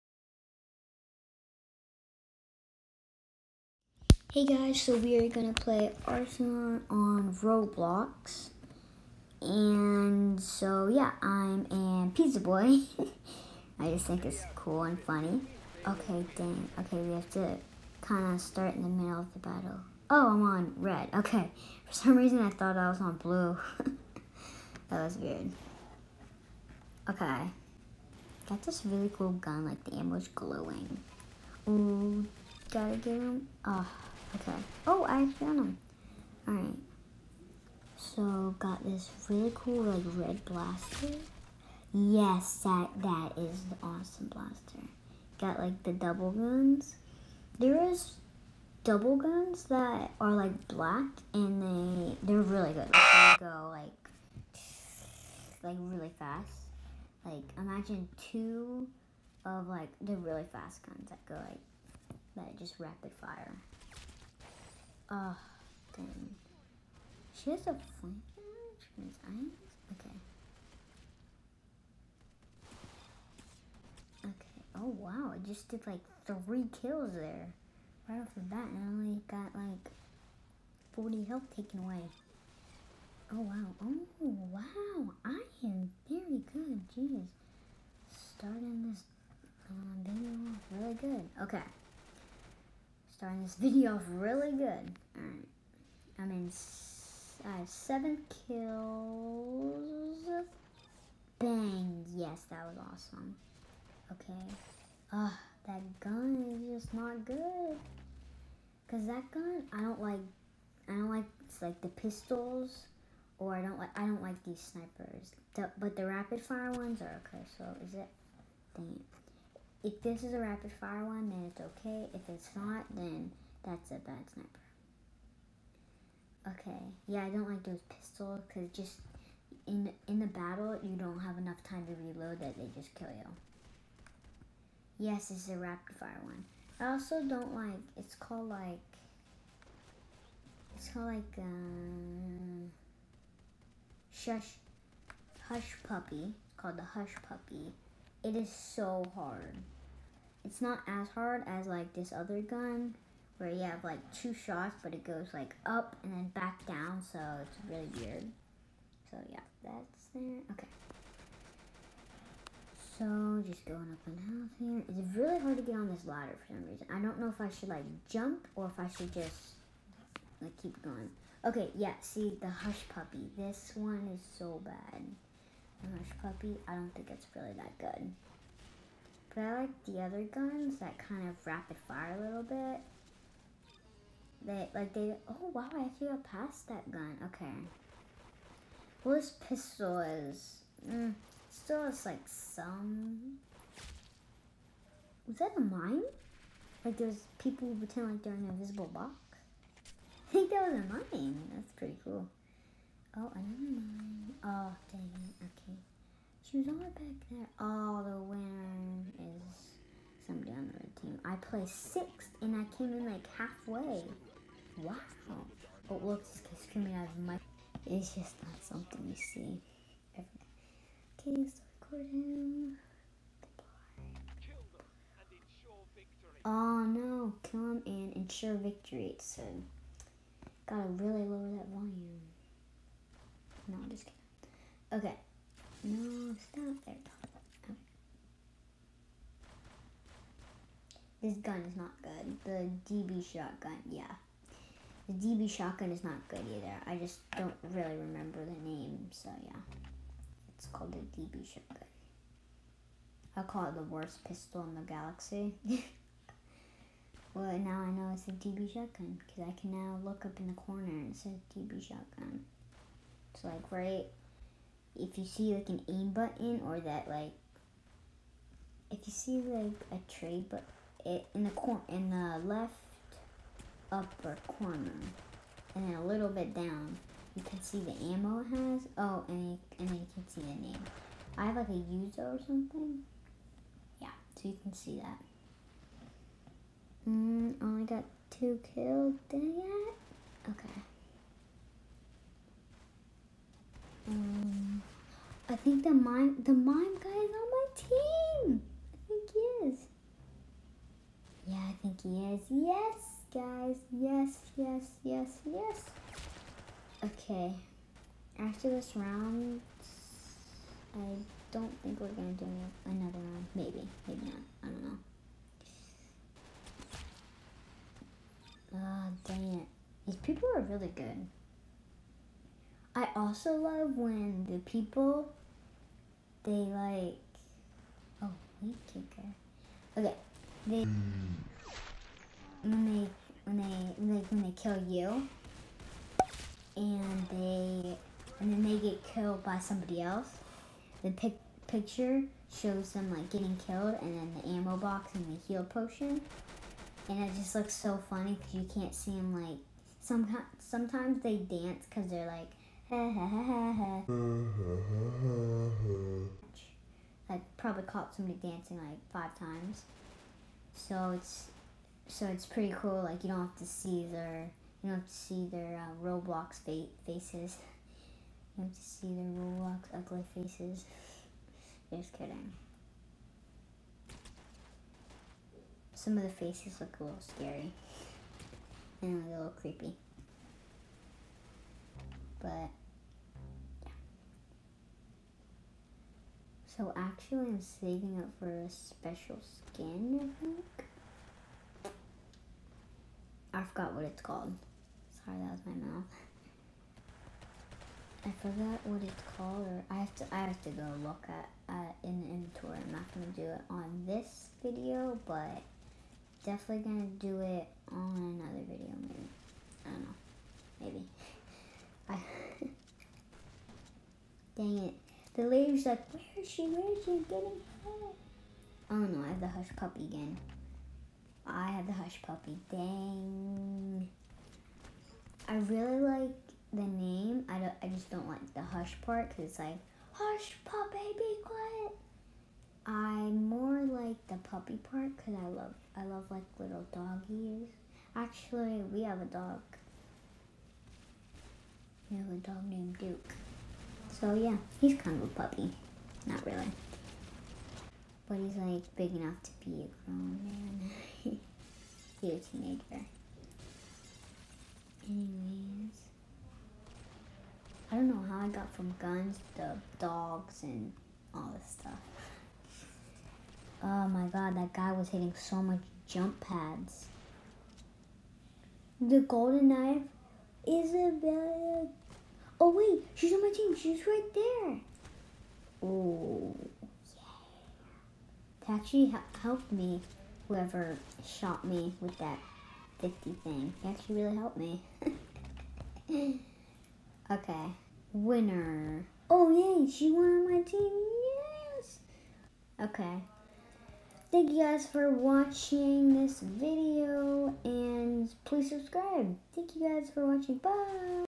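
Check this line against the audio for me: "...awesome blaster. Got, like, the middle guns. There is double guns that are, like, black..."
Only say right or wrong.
wrong.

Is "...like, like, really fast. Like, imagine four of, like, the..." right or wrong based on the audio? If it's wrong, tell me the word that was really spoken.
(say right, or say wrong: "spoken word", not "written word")
wrong: "two", not "four".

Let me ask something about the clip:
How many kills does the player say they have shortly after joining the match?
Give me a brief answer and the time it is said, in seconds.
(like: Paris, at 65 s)
7, at 97 s.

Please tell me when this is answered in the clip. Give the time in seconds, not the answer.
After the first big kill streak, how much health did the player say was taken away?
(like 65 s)
80 s.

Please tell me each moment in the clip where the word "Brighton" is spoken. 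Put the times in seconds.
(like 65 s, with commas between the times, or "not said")
not said.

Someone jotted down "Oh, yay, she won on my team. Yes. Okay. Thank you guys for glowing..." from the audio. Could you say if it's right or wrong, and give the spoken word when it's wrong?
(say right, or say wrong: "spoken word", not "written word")
wrong: "watching", not "glowing".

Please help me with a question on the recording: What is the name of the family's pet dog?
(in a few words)
Duke.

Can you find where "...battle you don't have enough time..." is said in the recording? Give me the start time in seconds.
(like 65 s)
130 s.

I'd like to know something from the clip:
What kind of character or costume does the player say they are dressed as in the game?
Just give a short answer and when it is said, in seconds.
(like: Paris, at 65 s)
pizza boy, at 12 s.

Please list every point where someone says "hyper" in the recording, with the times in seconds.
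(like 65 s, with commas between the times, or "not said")
not said.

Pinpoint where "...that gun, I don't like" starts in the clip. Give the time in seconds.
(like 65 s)
109 s.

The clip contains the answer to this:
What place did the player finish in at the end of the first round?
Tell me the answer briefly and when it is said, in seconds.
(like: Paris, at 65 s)
sixth, at 211 s.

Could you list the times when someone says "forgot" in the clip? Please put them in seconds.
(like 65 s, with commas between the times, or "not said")
393 s, 398 s.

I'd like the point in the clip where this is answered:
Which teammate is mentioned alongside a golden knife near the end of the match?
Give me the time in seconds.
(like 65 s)
470 s.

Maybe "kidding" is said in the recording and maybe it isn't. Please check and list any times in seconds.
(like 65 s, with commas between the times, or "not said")
234 s, 372 s.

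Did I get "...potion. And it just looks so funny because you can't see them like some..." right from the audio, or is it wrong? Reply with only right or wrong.
right.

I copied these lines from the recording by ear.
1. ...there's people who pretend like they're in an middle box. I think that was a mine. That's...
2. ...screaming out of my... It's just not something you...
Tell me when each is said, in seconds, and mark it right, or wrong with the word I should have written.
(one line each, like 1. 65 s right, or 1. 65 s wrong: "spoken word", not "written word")
1. 196 s wrong: "invisible", not "middle"
2. 216 s right.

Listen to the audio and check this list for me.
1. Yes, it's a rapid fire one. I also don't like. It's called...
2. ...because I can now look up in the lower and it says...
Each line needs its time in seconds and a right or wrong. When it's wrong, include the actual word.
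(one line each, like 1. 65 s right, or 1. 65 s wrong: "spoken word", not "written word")
1. 134 s right
2. 259 s wrong: "corner", not "lower".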